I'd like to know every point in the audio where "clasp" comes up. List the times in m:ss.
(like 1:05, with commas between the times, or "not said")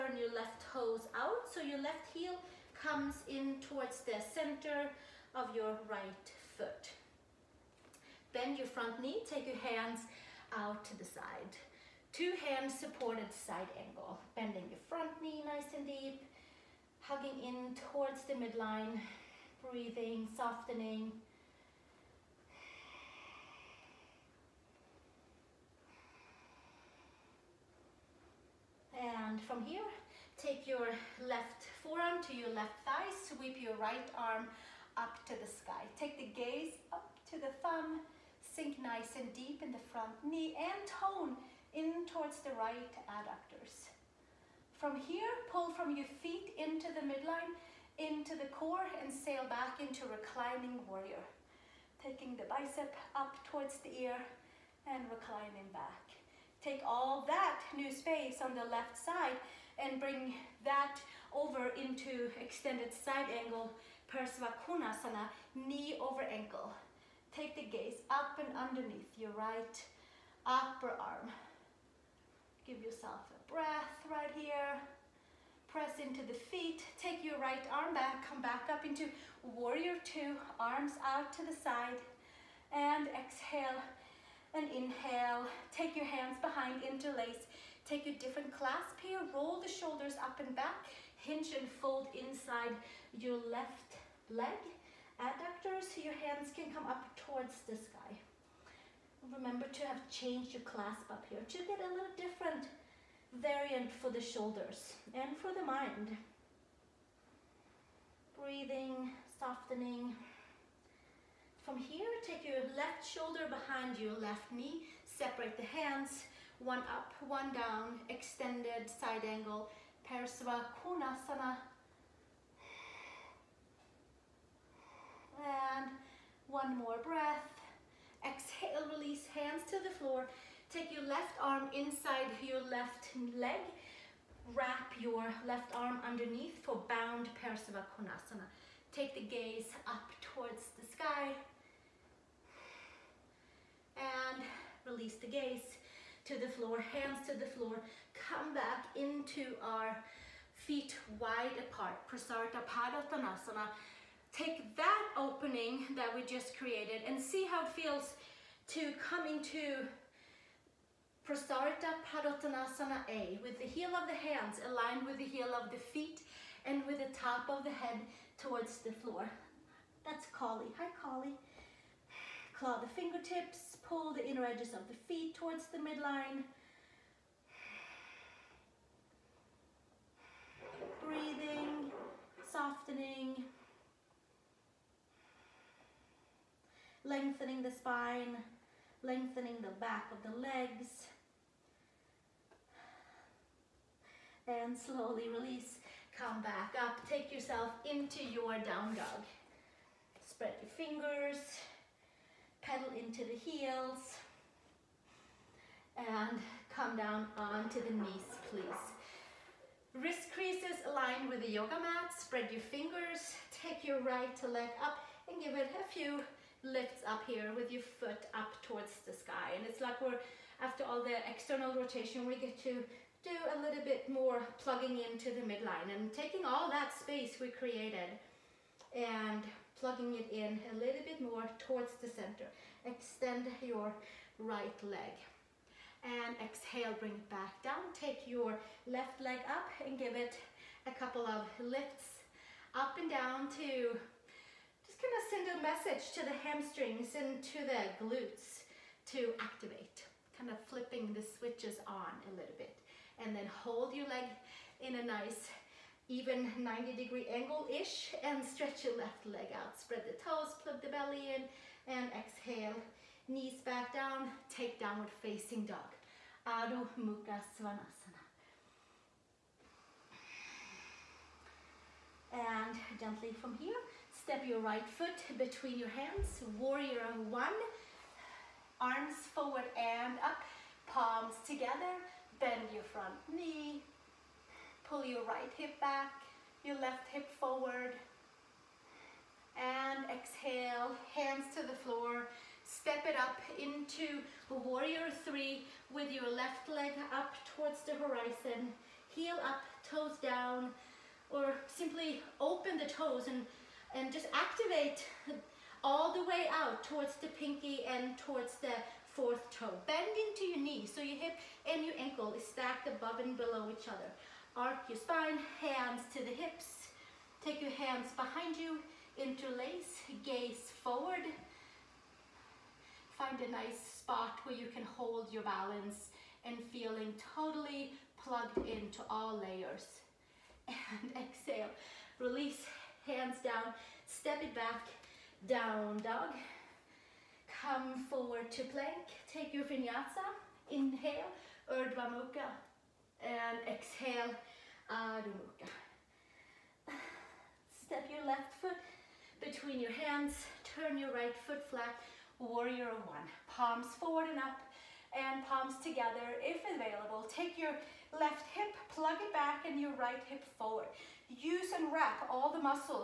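1:28, 1:40.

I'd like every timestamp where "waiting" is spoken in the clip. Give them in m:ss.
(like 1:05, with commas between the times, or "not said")
not said.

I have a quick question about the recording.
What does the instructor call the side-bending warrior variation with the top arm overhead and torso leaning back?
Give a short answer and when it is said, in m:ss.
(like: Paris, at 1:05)
reclining warrior, at 0:50.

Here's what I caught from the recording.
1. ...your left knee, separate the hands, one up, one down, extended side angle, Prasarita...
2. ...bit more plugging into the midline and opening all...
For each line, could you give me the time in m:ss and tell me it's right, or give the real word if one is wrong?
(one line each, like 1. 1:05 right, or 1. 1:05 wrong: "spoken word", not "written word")
1. 1:53 wrong: "Parasva", not "Prasarita"
2. 3:43 wrong: "taking", not "opening".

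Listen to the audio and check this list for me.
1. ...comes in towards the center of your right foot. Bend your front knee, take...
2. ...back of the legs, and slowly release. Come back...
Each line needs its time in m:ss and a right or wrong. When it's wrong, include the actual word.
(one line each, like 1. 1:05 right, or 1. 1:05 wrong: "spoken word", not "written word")
1. 0:02 right
2. 3:09 right.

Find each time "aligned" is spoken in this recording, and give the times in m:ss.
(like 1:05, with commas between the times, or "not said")
2:44, 3:30.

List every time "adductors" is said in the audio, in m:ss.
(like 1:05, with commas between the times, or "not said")
0:43, 1:35.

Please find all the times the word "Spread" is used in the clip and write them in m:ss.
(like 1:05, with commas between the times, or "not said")
3:20, 3:32, 4:19.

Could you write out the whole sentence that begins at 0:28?
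And from here, take your left forearm to your left thigh, sweep your right arm up to the sky.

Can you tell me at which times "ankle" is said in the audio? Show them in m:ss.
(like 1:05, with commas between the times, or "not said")
1:06, 5:11.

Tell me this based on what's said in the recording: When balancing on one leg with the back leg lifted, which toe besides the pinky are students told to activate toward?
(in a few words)
fourth toe.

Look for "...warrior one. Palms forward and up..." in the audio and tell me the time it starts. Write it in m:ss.
5:52.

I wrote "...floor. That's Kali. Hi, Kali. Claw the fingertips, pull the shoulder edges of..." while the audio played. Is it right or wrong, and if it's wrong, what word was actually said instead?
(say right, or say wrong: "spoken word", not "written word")
wrong: "inner", not "shoulder".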